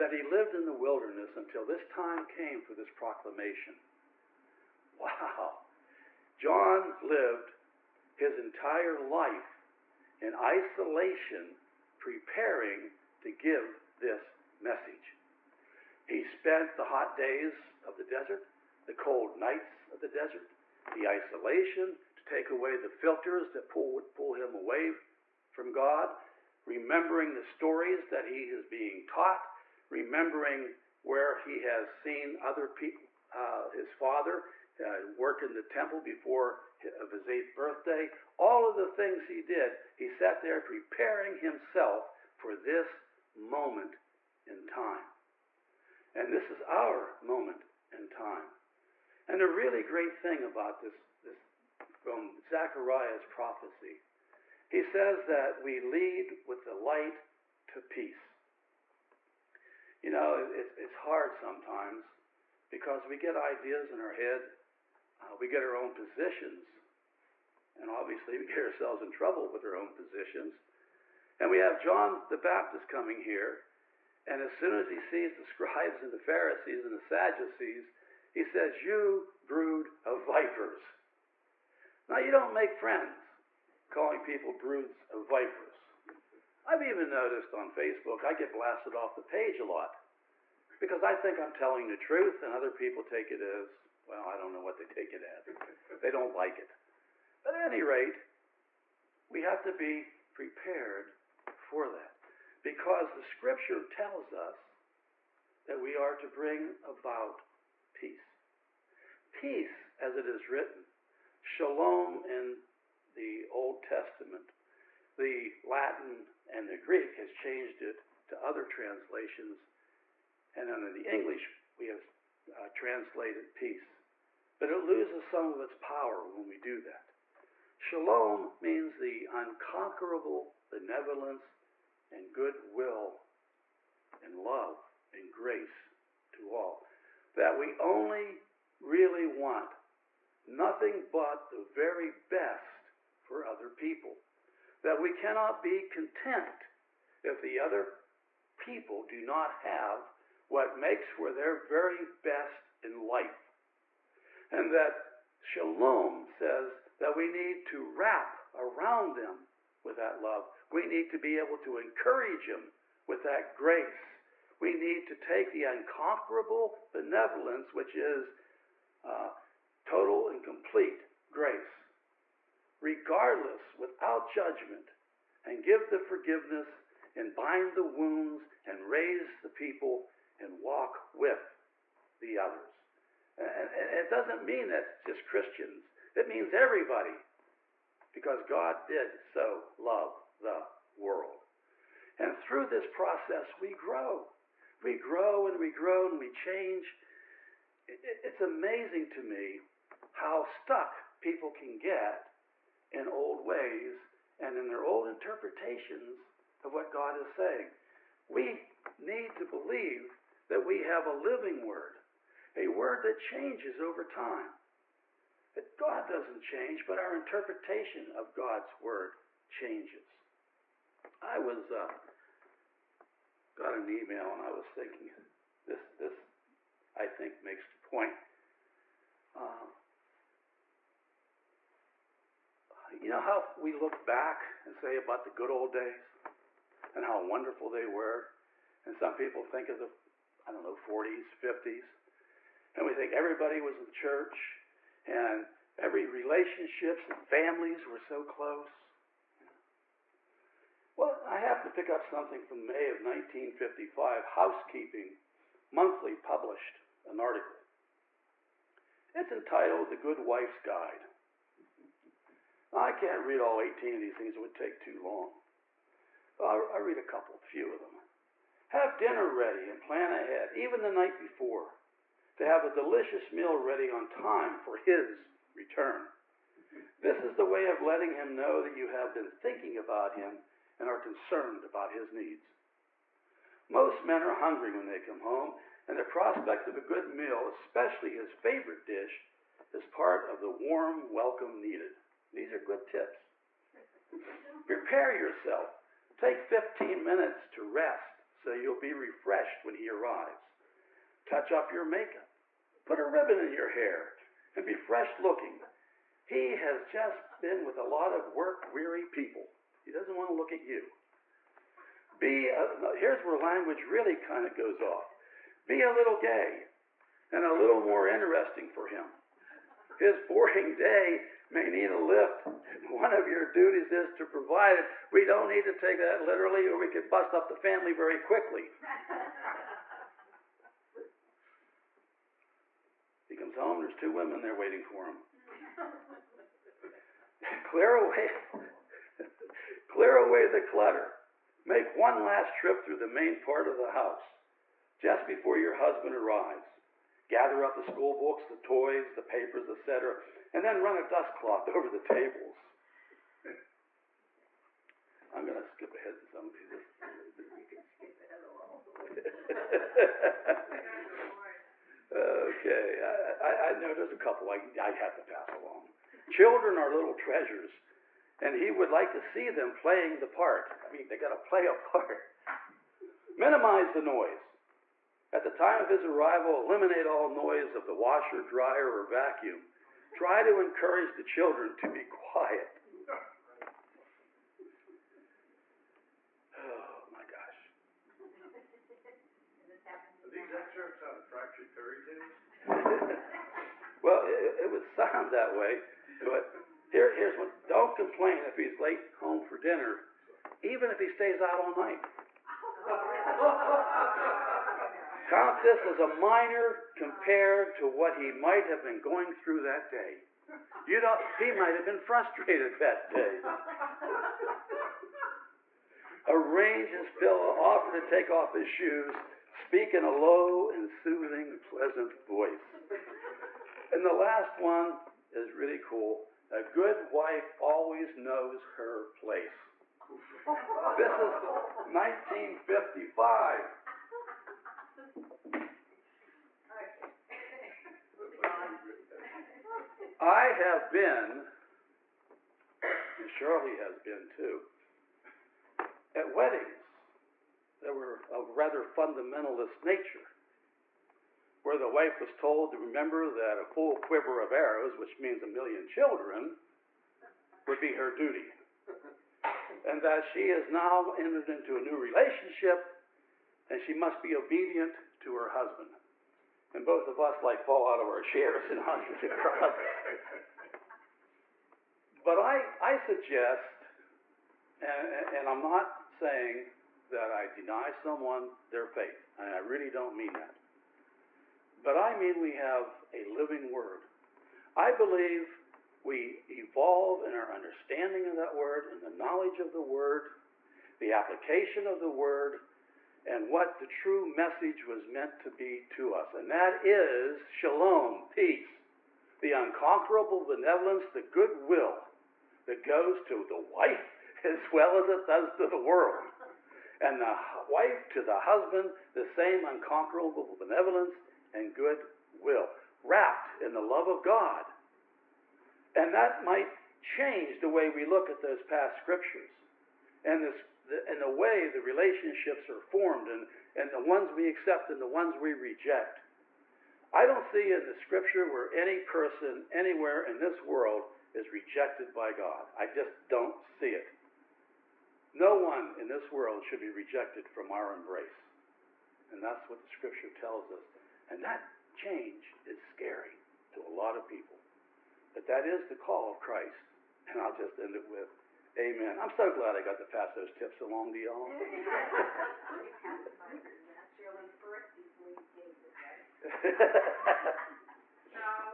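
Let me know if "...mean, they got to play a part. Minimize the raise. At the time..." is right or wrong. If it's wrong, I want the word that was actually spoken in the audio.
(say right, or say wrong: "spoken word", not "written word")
wrong: "noise", not "raise".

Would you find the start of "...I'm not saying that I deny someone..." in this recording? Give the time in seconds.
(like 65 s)
475 s.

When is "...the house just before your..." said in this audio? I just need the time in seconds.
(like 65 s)
343 s.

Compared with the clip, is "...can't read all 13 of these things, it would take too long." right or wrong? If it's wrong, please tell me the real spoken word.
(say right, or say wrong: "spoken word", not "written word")
wrong: "18", not "13".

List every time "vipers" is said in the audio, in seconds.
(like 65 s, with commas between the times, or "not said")
80 s, 85 s.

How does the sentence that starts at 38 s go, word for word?
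All of the things he did, he sat there preparing himself for this moment in time.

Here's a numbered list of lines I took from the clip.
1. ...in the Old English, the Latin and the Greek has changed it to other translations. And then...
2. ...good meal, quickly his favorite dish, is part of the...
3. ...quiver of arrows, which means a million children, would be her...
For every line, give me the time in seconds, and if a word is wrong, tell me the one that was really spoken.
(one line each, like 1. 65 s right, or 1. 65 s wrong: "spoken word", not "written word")
1. 112 s wrong: "Testament", not "English"
2. 286 s wrong: "especially", not "quickly"
3. 453 s right.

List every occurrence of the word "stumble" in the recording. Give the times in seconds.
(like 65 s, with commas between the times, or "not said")
not said.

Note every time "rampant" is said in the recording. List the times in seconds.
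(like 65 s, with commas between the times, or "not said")
not said.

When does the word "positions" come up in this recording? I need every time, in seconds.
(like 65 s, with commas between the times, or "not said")
65 s, 69 s.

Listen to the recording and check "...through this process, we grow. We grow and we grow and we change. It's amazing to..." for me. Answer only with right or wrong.
right.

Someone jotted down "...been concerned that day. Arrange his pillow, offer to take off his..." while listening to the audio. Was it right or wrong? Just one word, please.
wrong.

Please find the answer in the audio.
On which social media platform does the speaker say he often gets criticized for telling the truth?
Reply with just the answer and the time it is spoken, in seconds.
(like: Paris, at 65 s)
Facebook, at 87 s.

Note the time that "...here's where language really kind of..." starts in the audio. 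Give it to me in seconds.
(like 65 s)
312 s.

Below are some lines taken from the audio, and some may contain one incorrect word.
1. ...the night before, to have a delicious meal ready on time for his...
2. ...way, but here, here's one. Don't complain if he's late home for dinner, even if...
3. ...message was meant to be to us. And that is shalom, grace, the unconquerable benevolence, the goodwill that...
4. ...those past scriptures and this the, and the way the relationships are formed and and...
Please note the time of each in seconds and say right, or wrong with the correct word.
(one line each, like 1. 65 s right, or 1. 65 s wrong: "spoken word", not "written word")
1. 270 s right
2. 395 s right
3. 494 s wrong: "peace", not "grace"
4. 518 s right.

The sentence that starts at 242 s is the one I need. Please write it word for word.
And we think everybody was in church and every relationships and families were so close.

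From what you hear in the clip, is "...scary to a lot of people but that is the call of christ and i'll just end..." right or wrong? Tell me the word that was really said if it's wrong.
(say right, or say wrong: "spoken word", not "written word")
right.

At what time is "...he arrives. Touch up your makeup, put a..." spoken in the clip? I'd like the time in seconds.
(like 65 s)
299 s.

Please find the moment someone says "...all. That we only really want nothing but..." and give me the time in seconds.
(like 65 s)
136 s.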